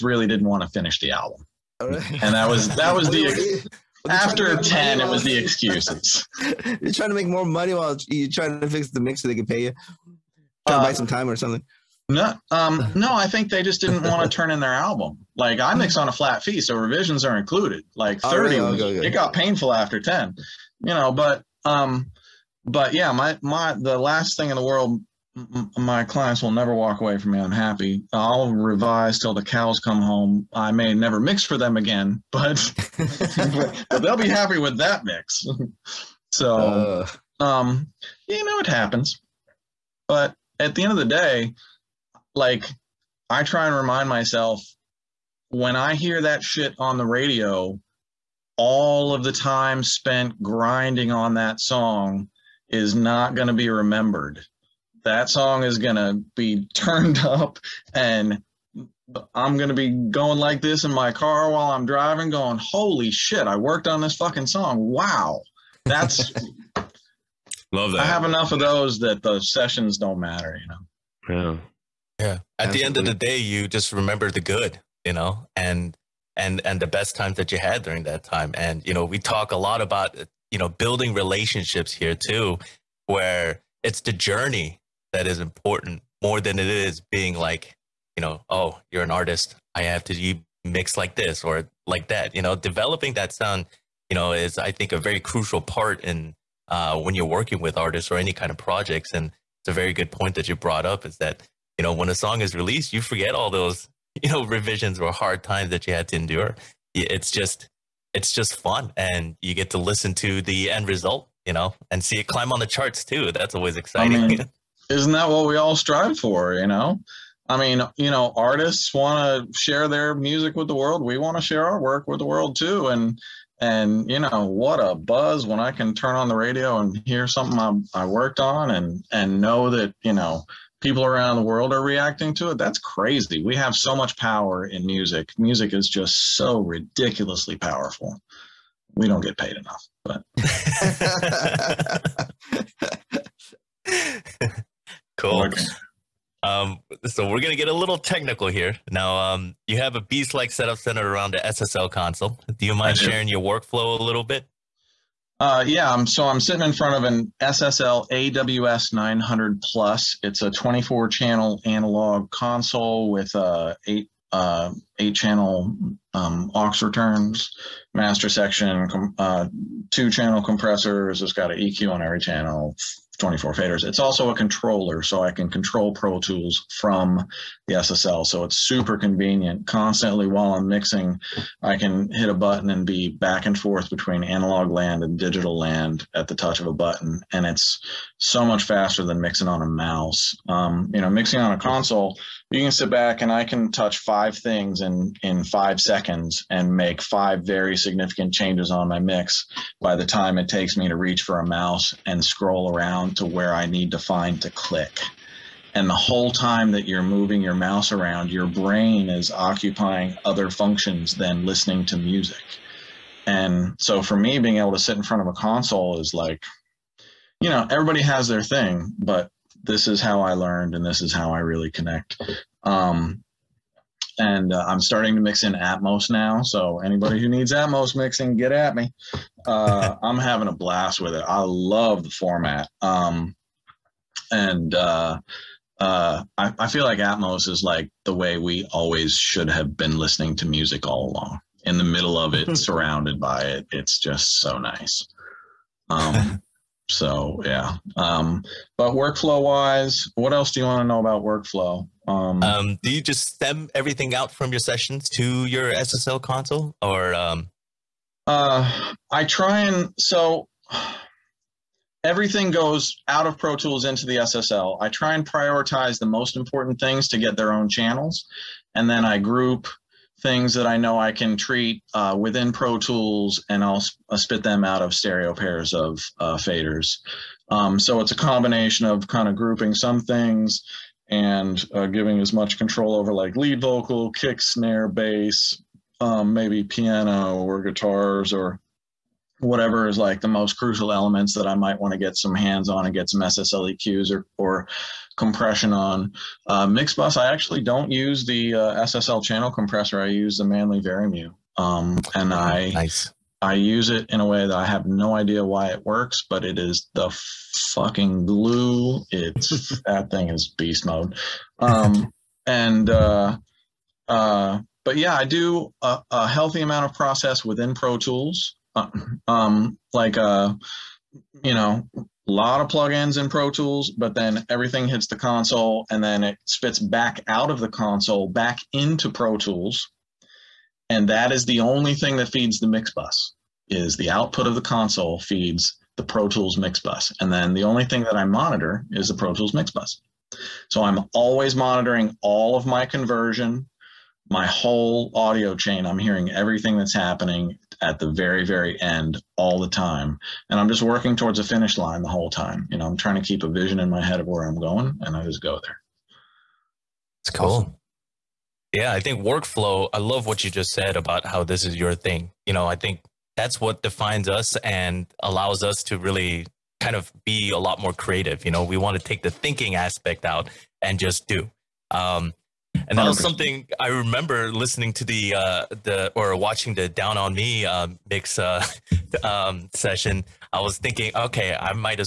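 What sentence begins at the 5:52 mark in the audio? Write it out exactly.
You know, I'm trying to keep a vision in my head of where I'm going and I just go there.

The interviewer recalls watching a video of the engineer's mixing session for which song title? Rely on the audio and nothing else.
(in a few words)
Down on Me.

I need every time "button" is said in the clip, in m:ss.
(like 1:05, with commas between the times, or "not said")
3:02, 3:06.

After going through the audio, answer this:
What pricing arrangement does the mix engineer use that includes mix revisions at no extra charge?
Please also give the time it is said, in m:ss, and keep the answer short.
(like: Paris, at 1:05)
flat fee, at 0:16.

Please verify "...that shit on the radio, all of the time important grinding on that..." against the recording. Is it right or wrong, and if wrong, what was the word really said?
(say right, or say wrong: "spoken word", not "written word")
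wrong: "spent", not "important".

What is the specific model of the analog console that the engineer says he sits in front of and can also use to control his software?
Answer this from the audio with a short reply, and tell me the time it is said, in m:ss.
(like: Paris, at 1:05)
AWS 900 Plus, at 2:38.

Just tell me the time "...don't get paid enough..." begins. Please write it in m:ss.
2:19.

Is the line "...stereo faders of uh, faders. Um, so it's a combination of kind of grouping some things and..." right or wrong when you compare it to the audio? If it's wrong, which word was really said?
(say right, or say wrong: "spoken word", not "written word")
wrong: "pairs", not "faders".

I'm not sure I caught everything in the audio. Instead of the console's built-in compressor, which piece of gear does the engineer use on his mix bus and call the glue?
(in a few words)
Manley Vari-Mu.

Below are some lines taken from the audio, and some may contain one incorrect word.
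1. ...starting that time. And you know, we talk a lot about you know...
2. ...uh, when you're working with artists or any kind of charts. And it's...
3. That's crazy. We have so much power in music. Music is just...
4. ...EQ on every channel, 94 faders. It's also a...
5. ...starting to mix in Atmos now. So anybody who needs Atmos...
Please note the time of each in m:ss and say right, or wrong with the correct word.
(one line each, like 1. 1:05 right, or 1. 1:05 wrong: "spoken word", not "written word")
1. 1:17 wrong: "during", not "starting"
2. 1:36 wrong: "projects", not "charts"
3. 2:12 right
4. 2:51 wrong: "24", not "94"
5. 3:44 right.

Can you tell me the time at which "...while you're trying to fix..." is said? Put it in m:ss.
0:07.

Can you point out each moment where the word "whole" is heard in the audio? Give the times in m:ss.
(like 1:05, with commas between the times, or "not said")
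3:25, 5:44, 5:52.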